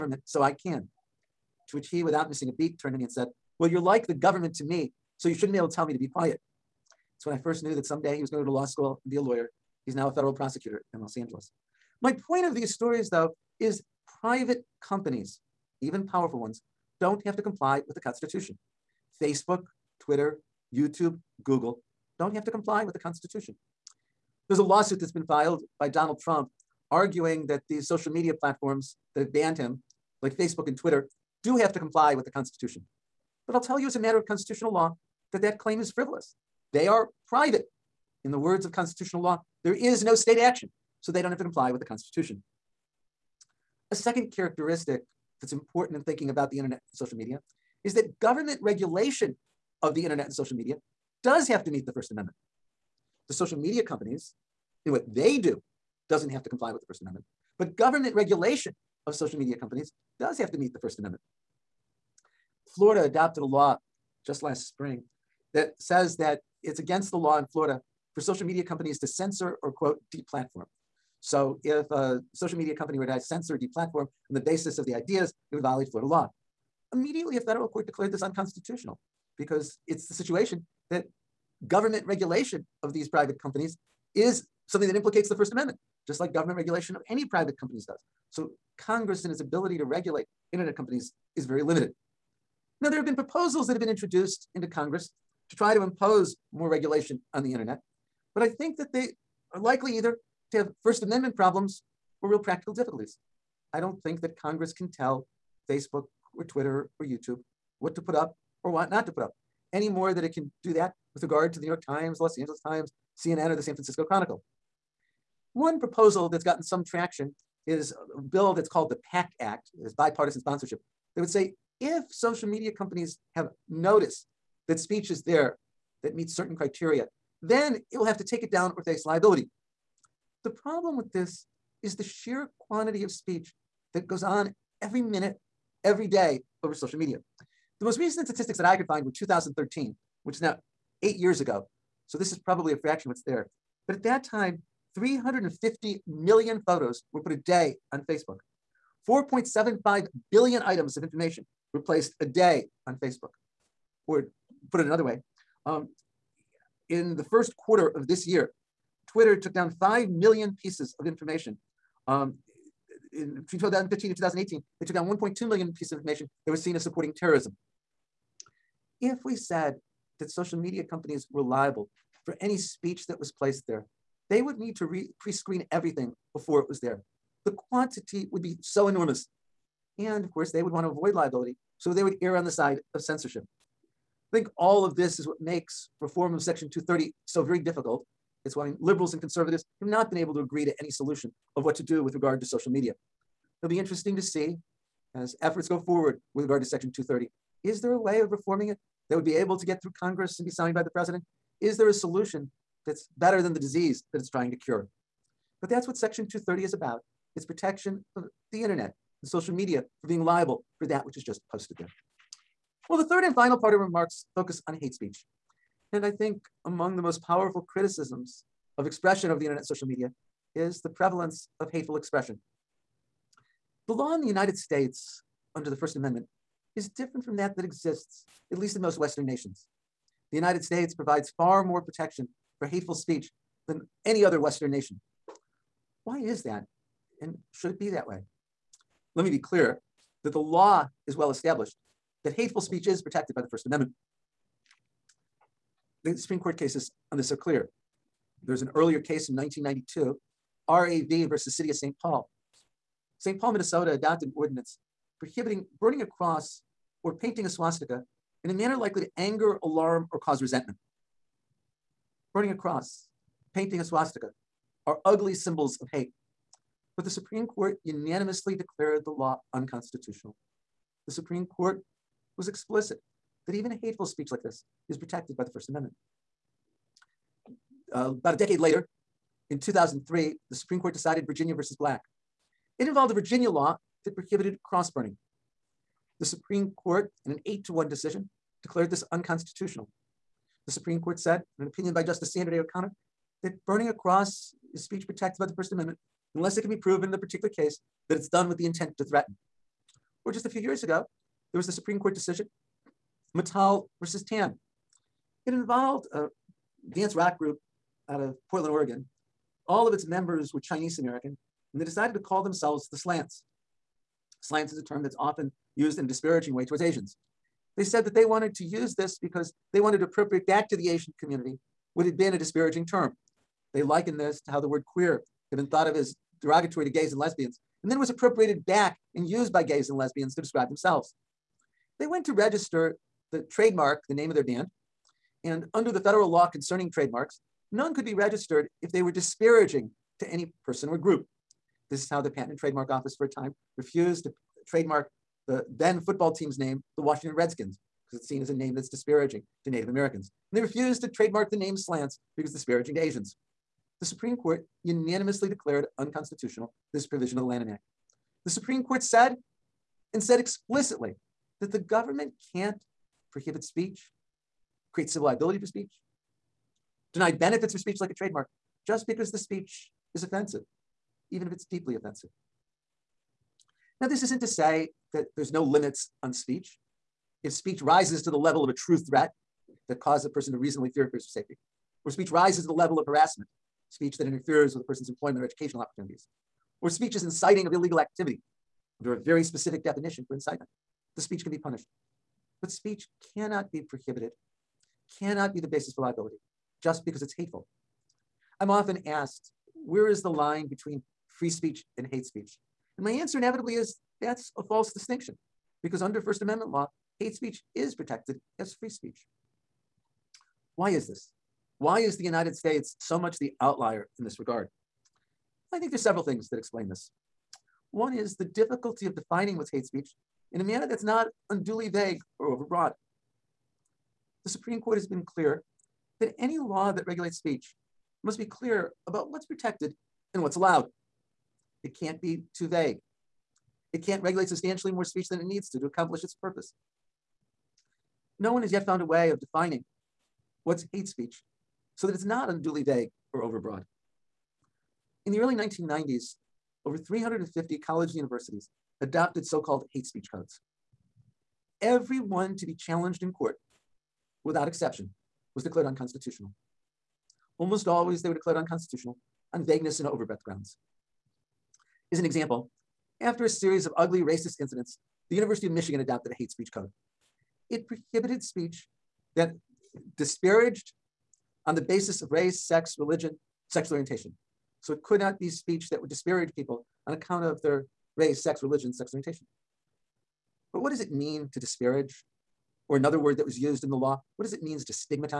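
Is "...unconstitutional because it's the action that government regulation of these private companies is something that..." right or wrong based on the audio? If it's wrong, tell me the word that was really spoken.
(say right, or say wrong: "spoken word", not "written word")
wrong: "situation", not "action".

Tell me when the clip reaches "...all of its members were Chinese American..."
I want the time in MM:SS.
05:09.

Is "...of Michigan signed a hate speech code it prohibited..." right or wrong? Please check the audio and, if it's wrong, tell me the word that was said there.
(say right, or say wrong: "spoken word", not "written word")
wrong: "adopted", not "signed".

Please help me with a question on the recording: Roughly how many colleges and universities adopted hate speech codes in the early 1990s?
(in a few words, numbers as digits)
over 350.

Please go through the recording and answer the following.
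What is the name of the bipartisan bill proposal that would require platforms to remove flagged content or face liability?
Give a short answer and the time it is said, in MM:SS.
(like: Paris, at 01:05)
PACT Act, at 01:59.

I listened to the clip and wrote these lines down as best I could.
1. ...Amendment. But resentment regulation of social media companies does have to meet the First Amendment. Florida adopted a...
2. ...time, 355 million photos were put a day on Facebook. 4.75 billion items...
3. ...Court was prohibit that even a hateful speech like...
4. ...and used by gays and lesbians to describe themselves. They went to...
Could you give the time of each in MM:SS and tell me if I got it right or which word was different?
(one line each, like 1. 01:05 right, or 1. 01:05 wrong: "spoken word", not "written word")
1. 00:57 wrong: "government", not "resentment"
2. 02:24 wrong: "350", not "355"
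3. 04:31 wrong: "explicit", not "prohibit"
4. 05:29 right.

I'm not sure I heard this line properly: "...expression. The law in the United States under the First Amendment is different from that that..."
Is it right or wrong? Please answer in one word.
right.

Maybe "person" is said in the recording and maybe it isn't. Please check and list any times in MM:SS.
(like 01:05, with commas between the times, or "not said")
05:40, 06:20, 06:24.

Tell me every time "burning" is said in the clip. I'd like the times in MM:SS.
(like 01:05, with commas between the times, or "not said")
04:15, 04:22, 04:44, 04:53.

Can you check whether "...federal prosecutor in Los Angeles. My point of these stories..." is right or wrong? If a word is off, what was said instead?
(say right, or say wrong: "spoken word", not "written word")
right.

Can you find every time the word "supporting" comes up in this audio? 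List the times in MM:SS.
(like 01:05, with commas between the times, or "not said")
02:46.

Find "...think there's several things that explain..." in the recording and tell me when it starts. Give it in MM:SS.
06:55.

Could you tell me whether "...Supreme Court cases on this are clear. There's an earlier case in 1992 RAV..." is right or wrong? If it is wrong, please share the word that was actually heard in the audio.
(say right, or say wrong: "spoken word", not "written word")
right.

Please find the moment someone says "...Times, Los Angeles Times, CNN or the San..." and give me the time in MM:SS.
01:51.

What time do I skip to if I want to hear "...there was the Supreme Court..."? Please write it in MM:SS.
05:01.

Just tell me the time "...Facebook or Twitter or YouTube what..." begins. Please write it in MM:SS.
01:45.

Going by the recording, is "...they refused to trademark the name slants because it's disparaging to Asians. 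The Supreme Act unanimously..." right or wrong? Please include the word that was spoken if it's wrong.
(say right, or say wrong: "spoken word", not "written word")
wrong: "Court", not "Act".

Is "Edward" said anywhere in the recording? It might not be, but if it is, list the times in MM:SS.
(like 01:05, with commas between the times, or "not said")
not said.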